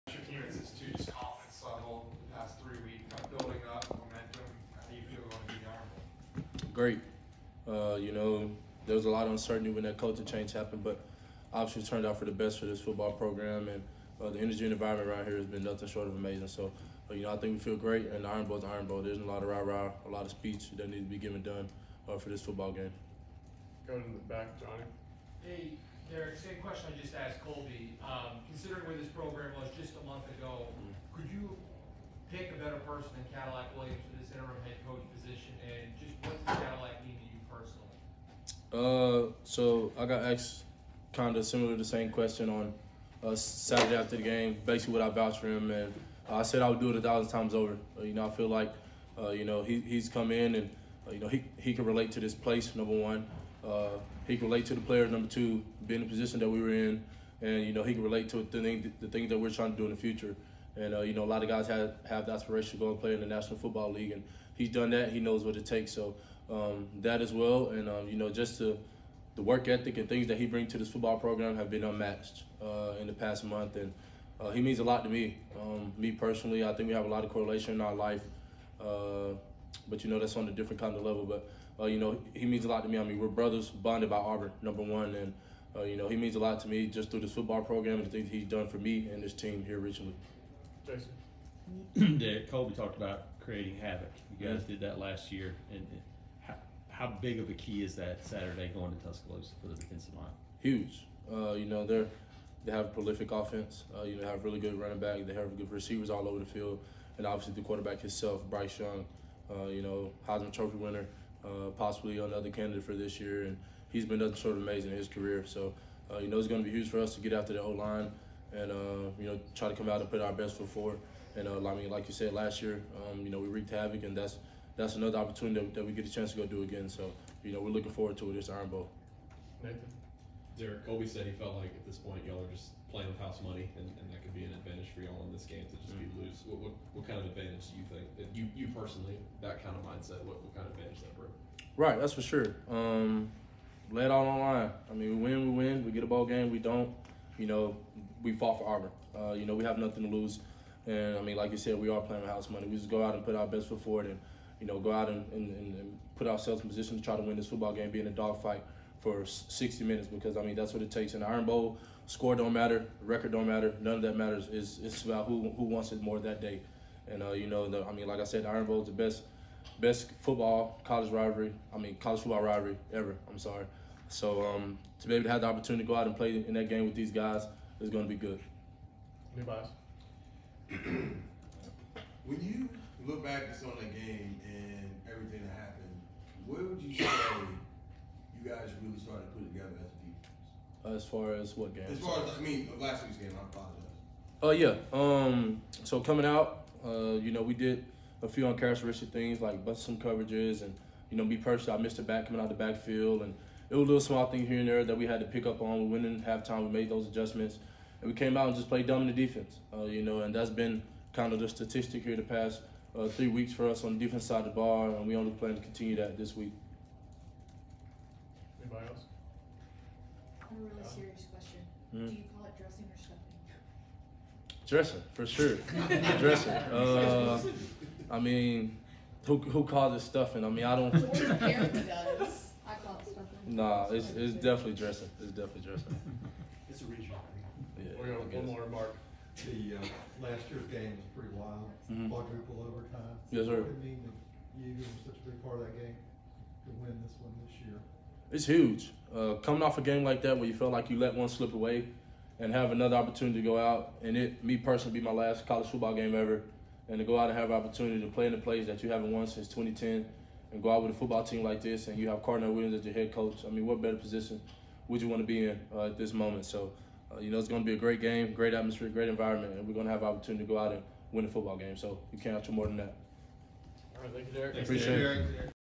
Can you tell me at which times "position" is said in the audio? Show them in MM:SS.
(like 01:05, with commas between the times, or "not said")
00:56, 02:36, 04:23.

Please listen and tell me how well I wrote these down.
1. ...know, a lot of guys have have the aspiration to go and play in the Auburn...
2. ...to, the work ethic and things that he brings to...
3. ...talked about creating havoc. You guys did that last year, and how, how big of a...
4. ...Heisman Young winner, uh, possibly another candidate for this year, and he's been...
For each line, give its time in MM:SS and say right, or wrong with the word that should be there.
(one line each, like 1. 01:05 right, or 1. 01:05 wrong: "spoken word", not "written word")
1. 01:01 wrong: "National", not "Auburn"
2. 01:08 right
3. 01:32 right
4. 01:50 wrong: "Trophy", not "Young".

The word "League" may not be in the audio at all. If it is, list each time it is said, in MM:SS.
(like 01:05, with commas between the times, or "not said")
01:03.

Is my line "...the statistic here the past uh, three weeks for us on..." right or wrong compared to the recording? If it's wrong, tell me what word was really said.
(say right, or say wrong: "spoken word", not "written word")
right.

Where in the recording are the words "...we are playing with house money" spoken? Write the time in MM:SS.
02:31.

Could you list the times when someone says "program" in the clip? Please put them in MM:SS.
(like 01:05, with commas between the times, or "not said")
00:13, 00:29, 01:11, 01:27.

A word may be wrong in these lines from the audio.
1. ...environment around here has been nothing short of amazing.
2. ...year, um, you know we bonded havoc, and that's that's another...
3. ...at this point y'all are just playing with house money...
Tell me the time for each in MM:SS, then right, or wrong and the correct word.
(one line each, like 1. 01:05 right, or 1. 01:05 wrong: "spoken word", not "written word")
1. 00:14 right
2. 02:02 wrong: "wreaked", not "bonded"
3. 02:11 right.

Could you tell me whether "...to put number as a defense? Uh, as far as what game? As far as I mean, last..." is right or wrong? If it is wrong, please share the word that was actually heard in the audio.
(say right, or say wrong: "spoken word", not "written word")
wrong: "together", not "number".